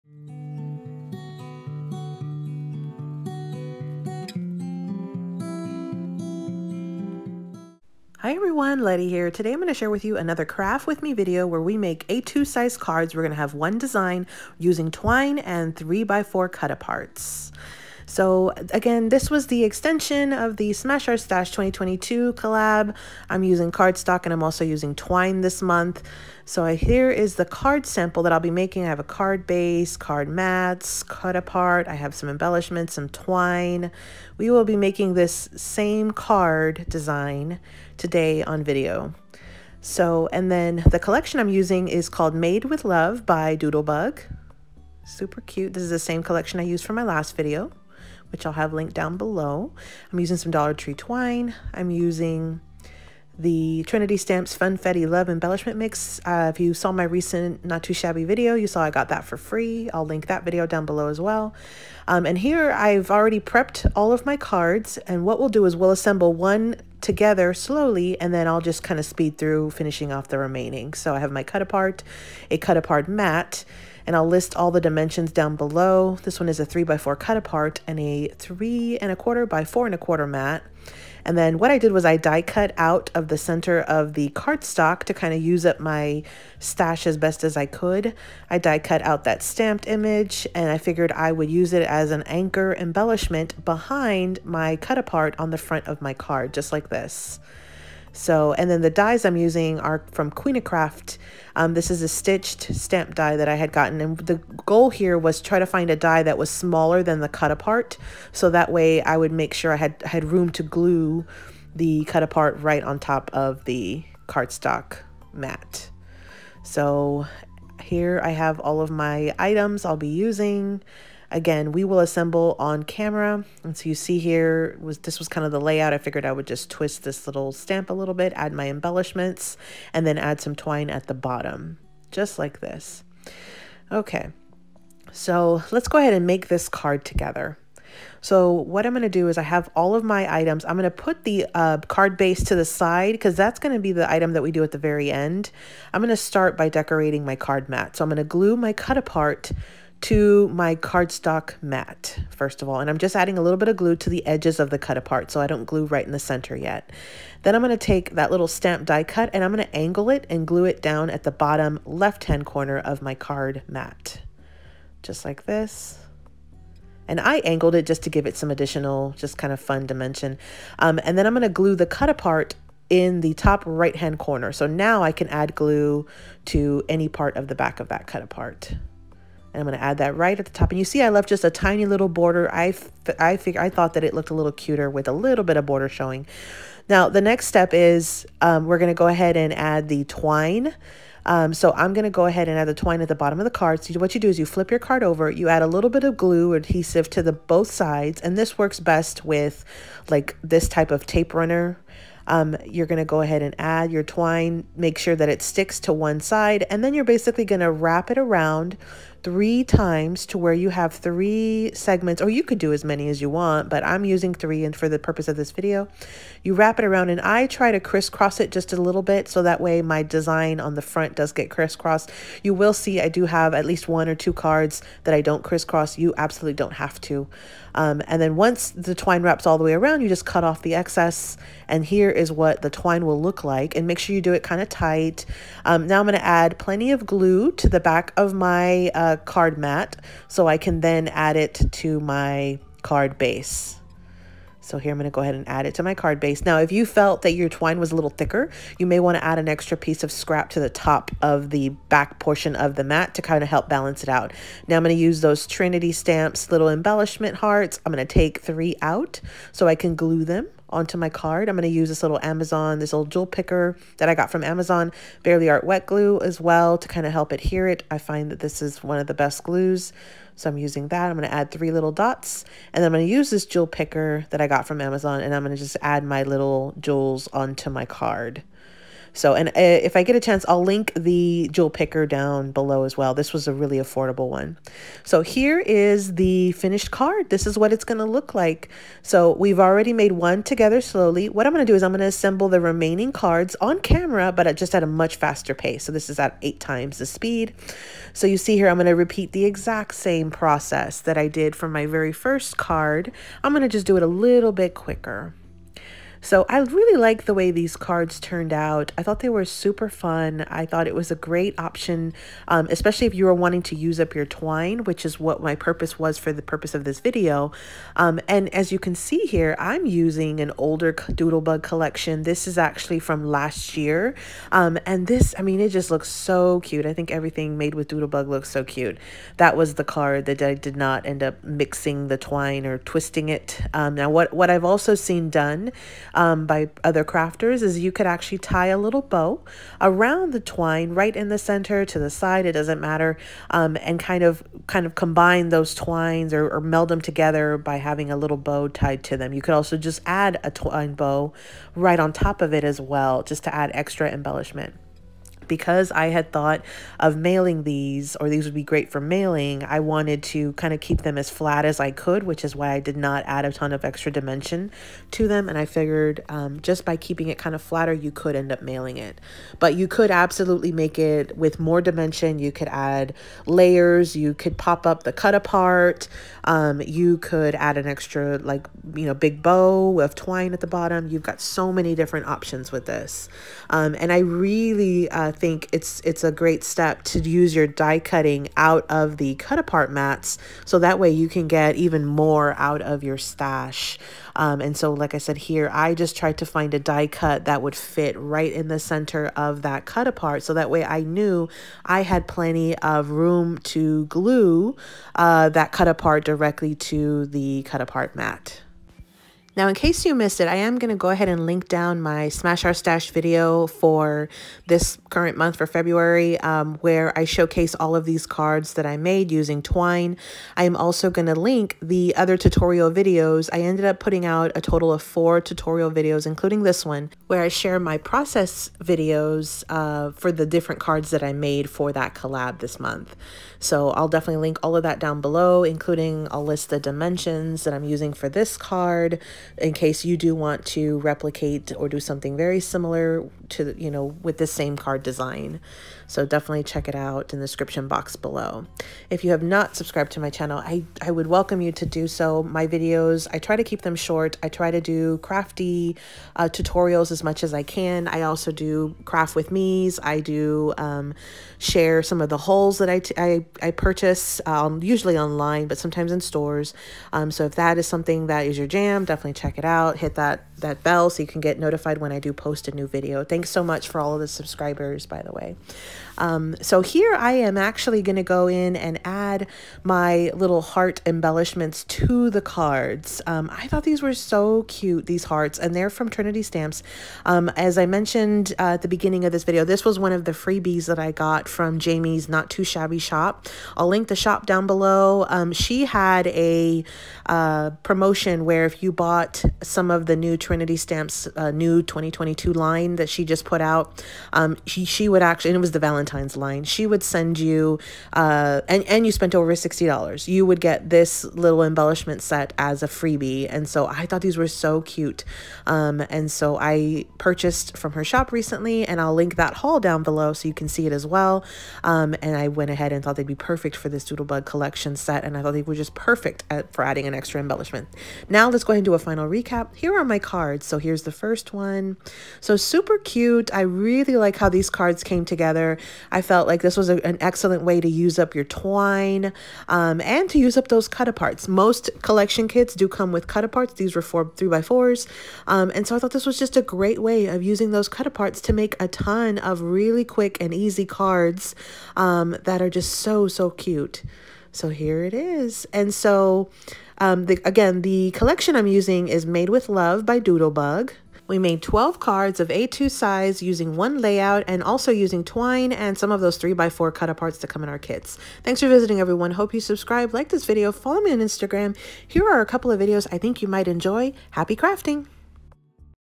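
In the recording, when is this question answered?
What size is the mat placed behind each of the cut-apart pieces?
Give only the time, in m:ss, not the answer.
1:18.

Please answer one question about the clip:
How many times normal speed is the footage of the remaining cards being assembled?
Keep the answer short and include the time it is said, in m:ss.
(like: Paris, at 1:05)
8, at 4:56.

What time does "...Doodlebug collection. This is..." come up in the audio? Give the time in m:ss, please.
5:20.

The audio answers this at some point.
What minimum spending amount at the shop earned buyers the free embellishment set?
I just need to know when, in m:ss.
8:29.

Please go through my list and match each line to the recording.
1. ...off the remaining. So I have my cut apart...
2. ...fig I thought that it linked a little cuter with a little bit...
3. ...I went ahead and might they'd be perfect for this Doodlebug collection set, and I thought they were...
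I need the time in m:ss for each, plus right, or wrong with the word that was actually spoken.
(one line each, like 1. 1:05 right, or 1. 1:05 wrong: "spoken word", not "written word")
1. 1:10 right
2. 3:03 wrong: "looked", not "linked"
3. 8:42 wrong: "thought", not "might".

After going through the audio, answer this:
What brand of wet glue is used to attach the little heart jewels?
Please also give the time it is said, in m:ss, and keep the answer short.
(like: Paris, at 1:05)
Bearly Art, at 4:25.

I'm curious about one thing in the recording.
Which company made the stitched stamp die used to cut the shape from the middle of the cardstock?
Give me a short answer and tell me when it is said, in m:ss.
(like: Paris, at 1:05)
Queenacraft, at 1:40.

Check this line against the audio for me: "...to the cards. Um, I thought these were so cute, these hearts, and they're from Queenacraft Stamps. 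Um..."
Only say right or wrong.
wrong.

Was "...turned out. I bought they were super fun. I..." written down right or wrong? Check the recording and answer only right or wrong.
wrong.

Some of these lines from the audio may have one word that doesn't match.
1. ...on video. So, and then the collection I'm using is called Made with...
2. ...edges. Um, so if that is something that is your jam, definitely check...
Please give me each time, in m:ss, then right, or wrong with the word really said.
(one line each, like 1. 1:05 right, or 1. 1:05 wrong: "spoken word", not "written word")
1. 0:38 right
2. 7:46 wrong: "stores", not "edges".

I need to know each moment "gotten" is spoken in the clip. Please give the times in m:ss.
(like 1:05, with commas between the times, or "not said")
1:43.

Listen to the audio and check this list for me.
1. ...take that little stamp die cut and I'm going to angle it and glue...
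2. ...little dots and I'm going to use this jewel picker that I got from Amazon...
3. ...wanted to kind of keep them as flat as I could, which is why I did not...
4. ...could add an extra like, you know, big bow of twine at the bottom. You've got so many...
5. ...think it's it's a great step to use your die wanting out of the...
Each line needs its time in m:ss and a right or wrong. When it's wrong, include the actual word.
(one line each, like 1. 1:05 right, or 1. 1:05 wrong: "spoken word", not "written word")
1. 2:37 right
2. 4:31 right
3. 5:59 right
4. 6:17 right
5. 6:25 wrong: "cutting", not "wanting".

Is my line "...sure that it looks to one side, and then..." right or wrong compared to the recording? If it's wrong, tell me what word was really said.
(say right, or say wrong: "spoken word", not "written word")
wrong: "sticks", not "looks".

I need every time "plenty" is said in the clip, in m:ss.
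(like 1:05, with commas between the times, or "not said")
3:56, 6:42.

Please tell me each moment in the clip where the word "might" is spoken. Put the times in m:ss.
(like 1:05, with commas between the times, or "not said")
9:33.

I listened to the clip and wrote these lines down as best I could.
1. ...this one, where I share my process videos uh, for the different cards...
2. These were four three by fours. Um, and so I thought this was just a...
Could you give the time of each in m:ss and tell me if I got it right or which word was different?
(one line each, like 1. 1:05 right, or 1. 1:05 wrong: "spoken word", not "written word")
1. 7:06 right
2. 9:03 right.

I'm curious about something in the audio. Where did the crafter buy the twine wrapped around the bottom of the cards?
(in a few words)
Dollar Tree.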